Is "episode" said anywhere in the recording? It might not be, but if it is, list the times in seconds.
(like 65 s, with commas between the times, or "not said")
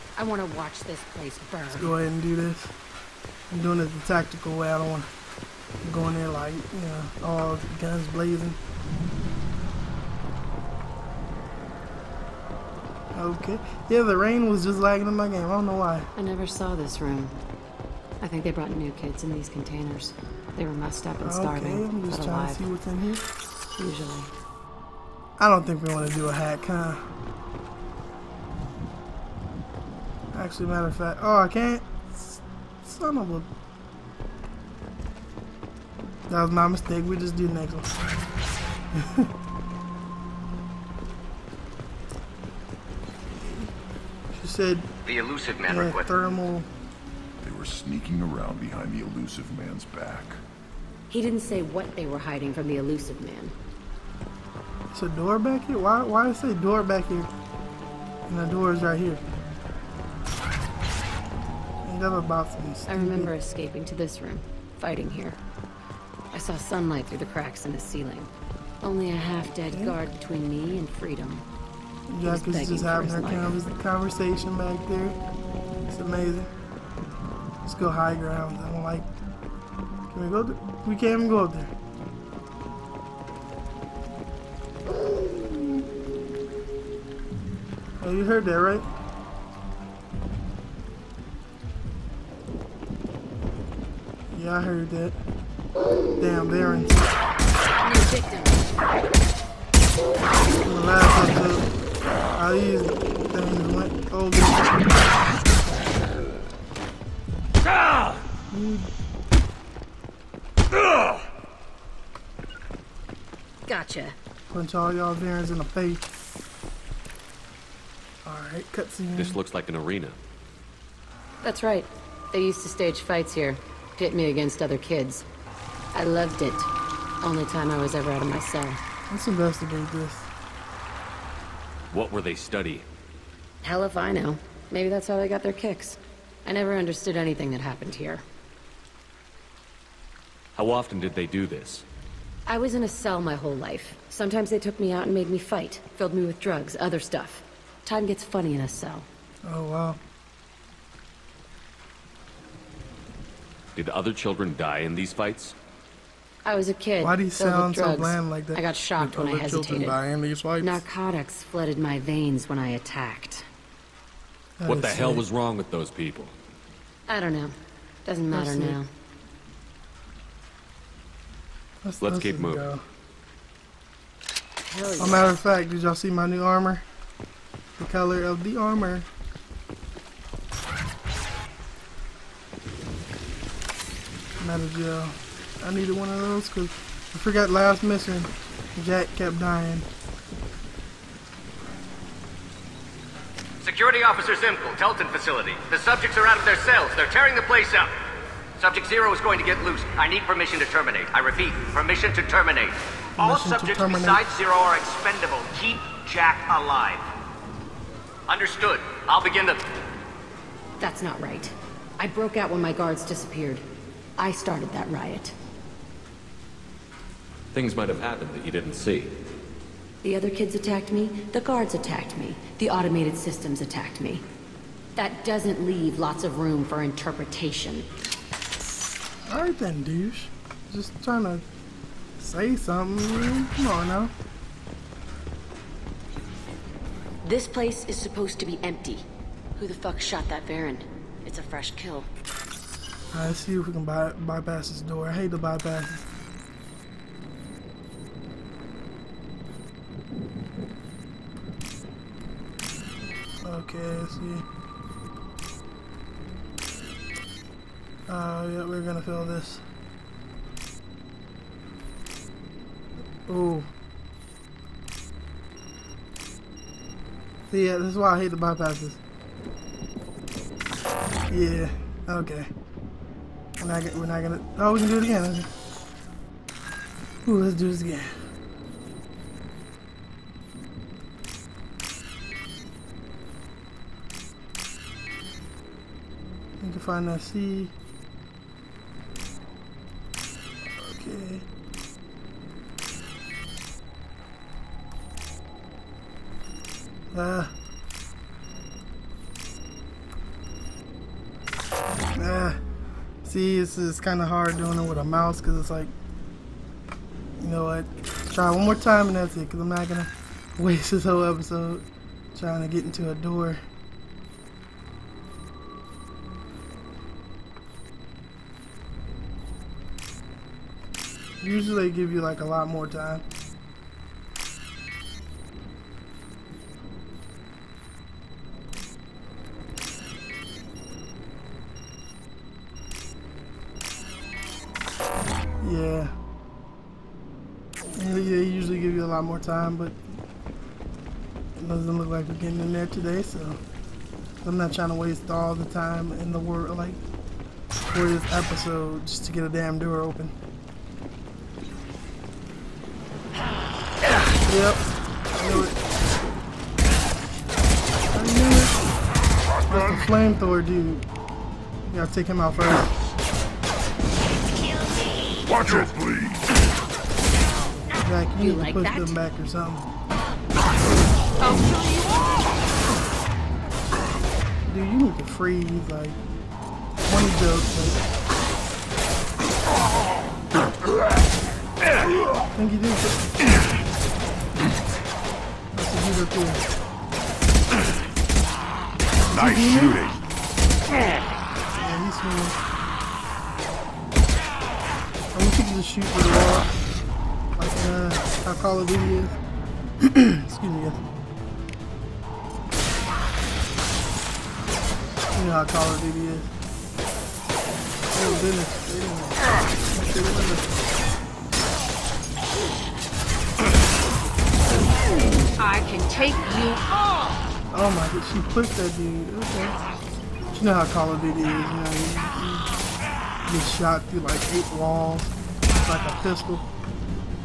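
101 s, 311 s, 348 s.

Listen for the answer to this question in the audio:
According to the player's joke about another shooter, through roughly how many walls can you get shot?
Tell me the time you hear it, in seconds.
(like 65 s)
424 s.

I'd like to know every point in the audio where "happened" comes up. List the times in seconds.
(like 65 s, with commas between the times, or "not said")
137 s, 218 s.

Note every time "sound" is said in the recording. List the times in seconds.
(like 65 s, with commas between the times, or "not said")
157 s.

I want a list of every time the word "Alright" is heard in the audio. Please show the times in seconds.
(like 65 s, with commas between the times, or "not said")
118 s, 229 s.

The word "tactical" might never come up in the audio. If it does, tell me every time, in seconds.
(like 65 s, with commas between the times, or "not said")
4 s.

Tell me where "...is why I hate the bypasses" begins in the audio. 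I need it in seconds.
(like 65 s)
267 s.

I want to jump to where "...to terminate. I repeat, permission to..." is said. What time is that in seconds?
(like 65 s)
200 s.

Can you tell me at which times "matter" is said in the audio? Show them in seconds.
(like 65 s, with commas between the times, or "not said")
30 s, 168 s, 175 s.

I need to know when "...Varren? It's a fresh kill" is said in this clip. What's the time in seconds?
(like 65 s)
240 s.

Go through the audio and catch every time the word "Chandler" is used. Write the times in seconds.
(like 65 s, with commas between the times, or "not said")
not said.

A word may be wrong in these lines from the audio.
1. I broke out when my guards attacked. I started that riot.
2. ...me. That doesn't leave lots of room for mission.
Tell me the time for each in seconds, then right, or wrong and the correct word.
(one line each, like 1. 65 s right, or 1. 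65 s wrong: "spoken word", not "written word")
1. 211 s wrong: "disappeared", not "attacked"
2. 224 s wrong: "interpretation", not "mission".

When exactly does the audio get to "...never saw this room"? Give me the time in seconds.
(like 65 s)
16 s.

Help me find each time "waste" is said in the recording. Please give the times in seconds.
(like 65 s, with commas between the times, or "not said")
310 s, 344 s.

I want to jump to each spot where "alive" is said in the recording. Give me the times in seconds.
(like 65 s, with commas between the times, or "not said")
22 s, 206 s.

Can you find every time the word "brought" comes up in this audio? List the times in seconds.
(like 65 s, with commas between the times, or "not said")
18 s.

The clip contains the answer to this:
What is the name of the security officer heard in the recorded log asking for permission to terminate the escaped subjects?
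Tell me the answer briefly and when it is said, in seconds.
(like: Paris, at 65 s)
Zimkel, at 194 s.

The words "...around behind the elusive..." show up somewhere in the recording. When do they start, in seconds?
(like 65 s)
48 s.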